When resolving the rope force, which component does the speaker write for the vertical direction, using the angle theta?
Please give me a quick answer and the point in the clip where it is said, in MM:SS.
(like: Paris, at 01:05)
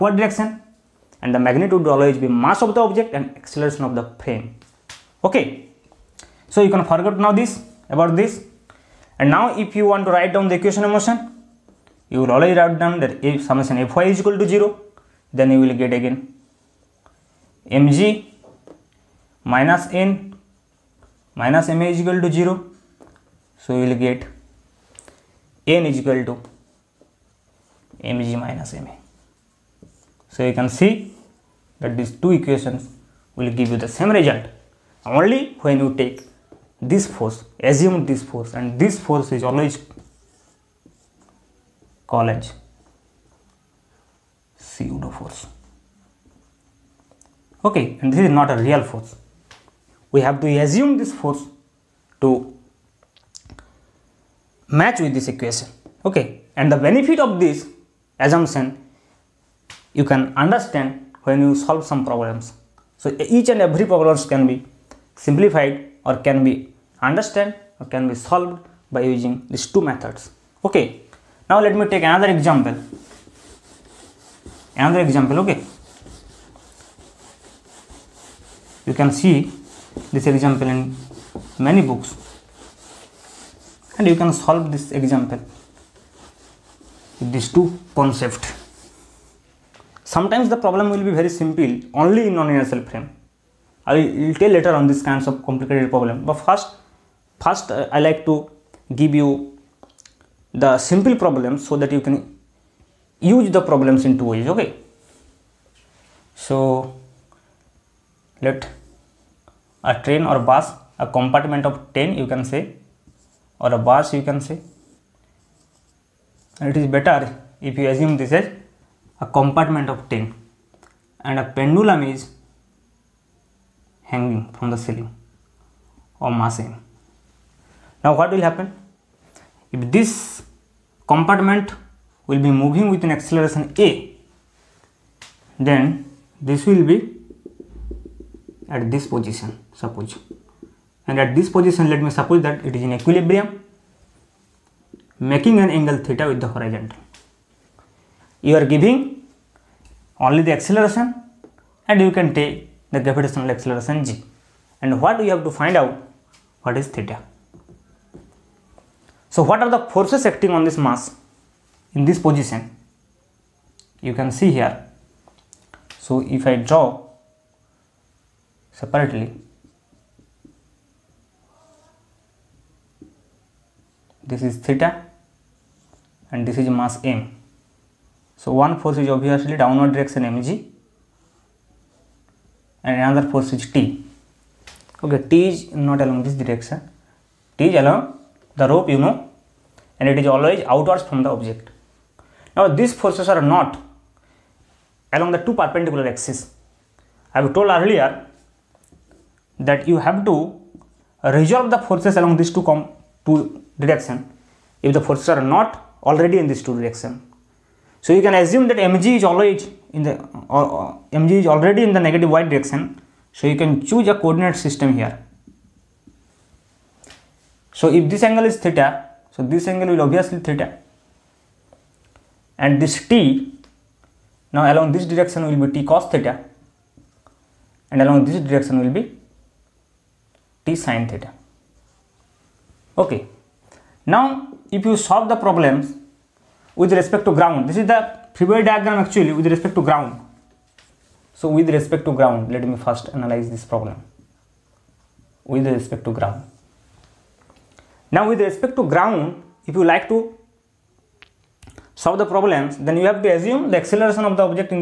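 t cos theta, at 03:45.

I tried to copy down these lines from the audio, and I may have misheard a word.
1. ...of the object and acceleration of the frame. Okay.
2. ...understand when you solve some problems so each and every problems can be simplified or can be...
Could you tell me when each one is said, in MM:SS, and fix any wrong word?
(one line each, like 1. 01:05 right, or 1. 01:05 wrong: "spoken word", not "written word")
1. 00:02 right
2. 01:00 right.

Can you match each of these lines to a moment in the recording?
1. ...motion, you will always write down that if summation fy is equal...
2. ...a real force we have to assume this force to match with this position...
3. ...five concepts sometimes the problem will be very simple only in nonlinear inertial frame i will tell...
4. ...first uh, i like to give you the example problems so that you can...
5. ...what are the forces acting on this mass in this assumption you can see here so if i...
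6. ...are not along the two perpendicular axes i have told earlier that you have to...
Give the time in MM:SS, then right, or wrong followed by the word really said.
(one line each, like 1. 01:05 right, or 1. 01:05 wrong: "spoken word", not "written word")
1. 00:10 right
2. 00:48 wrong: "equation", not "position"
3. 01:27 wrong: "two", not "five"
4. 01:37 wrong: "simple", not "example"
5. 02:39 wrong: "position", not "assumption"
6. 03:13 right.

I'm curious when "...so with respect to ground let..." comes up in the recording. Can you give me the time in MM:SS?
04:01.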